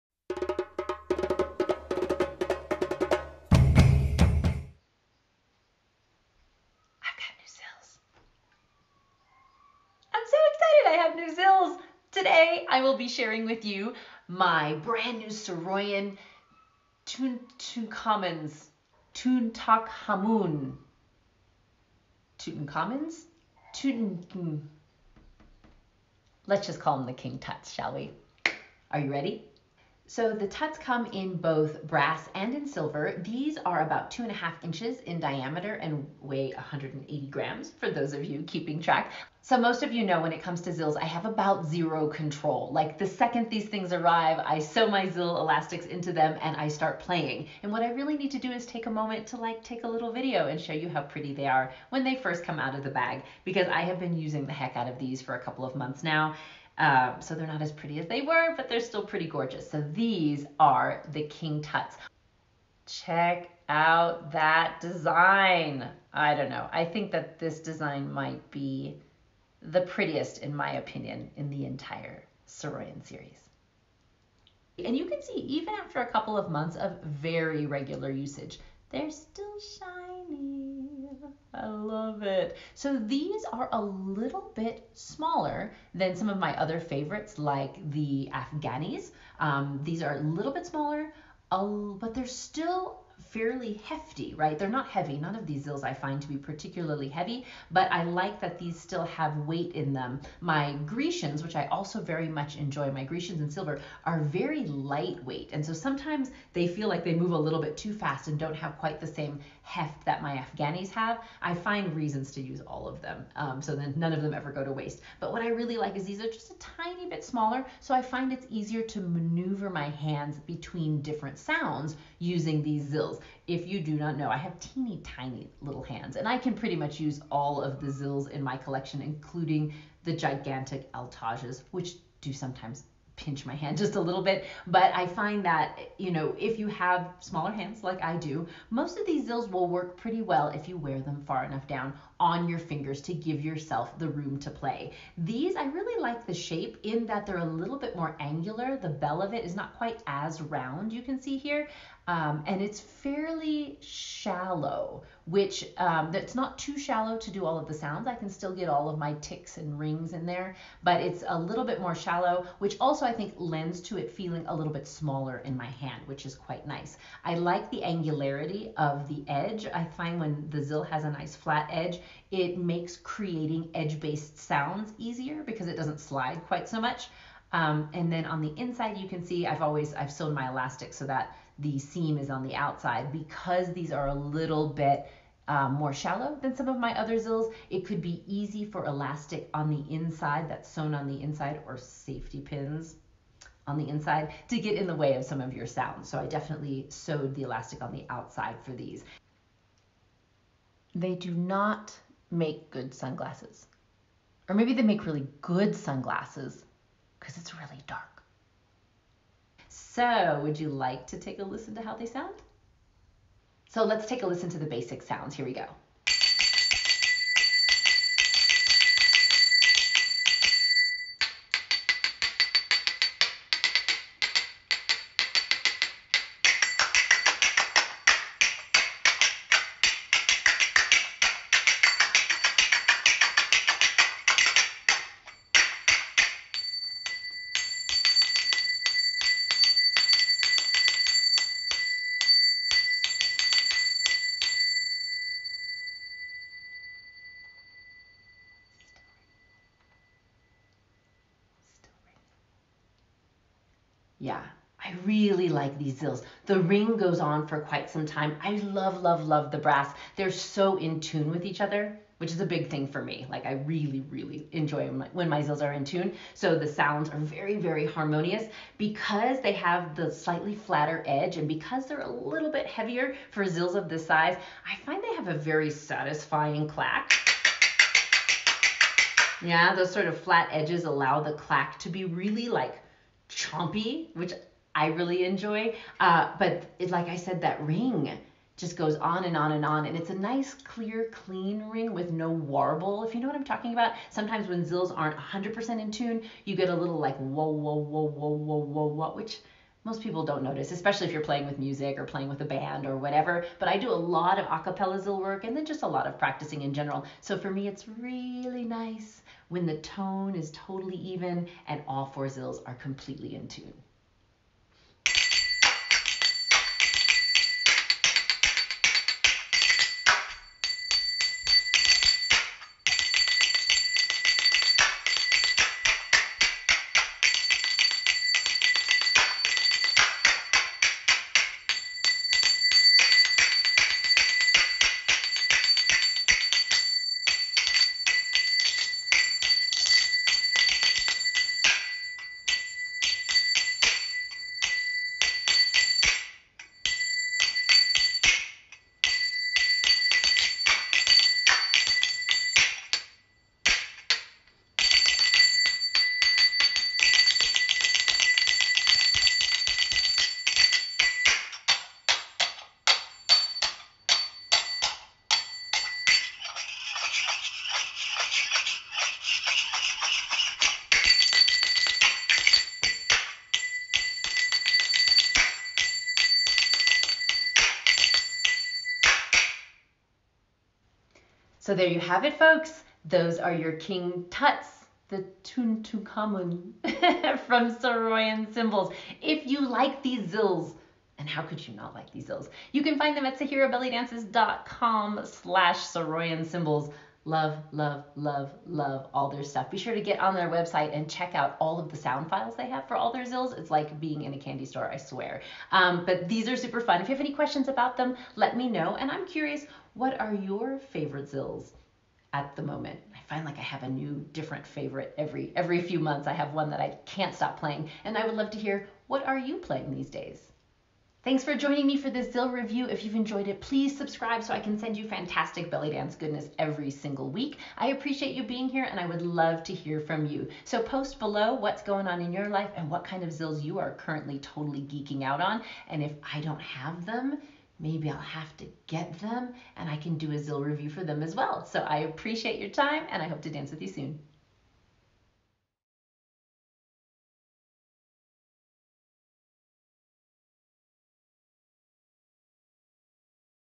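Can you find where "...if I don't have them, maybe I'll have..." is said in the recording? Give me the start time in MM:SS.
07:16.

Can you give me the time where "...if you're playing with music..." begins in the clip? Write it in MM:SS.
05:01.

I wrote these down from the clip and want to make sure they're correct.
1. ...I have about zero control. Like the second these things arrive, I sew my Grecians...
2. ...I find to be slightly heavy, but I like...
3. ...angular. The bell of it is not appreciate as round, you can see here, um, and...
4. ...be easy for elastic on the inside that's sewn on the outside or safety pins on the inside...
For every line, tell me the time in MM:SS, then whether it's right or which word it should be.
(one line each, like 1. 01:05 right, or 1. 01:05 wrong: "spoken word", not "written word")
1. 00:41 wrong: "Zill", not "Grecians"
2. 01:35 wrong: "particularly", not "slightly"
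3. 02:28 wrong: "quite", not "appreciate"
4. 03:08 wrong: "inside", not "outside".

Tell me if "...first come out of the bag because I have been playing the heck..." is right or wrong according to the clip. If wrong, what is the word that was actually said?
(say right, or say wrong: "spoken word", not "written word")
wrong: "using", not "playing".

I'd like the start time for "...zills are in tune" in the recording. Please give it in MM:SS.
04:25.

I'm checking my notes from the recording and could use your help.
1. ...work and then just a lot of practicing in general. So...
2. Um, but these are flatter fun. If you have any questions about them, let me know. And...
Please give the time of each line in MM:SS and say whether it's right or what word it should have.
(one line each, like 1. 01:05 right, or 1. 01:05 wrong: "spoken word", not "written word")
1. 05:05 right
2. 06:45 wrong: "super", not "flatter".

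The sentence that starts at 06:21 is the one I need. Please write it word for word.
So there you have it, folks.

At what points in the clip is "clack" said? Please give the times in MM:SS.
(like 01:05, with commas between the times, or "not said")
04:36, 04:41.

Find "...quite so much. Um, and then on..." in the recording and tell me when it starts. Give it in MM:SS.
02:56.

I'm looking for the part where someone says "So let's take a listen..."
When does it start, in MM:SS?
03:33.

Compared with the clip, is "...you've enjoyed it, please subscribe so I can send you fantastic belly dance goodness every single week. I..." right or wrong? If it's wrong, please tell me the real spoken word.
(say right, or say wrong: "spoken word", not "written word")
right.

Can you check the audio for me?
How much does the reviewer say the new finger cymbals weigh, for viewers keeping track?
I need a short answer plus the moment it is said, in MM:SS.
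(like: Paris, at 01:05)
180 grams, at 00:36.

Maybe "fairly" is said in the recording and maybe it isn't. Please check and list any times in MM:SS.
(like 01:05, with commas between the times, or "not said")
01:33, 02:32.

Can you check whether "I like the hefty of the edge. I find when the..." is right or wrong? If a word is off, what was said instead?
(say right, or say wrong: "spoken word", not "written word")
wrong: "angularity", not "hefty".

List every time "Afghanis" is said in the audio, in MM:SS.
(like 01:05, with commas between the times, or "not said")
01:28, 01:50.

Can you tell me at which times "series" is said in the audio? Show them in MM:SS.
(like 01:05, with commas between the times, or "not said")
01:13.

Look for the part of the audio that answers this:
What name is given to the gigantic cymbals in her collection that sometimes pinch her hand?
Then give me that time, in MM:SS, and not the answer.
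02:10.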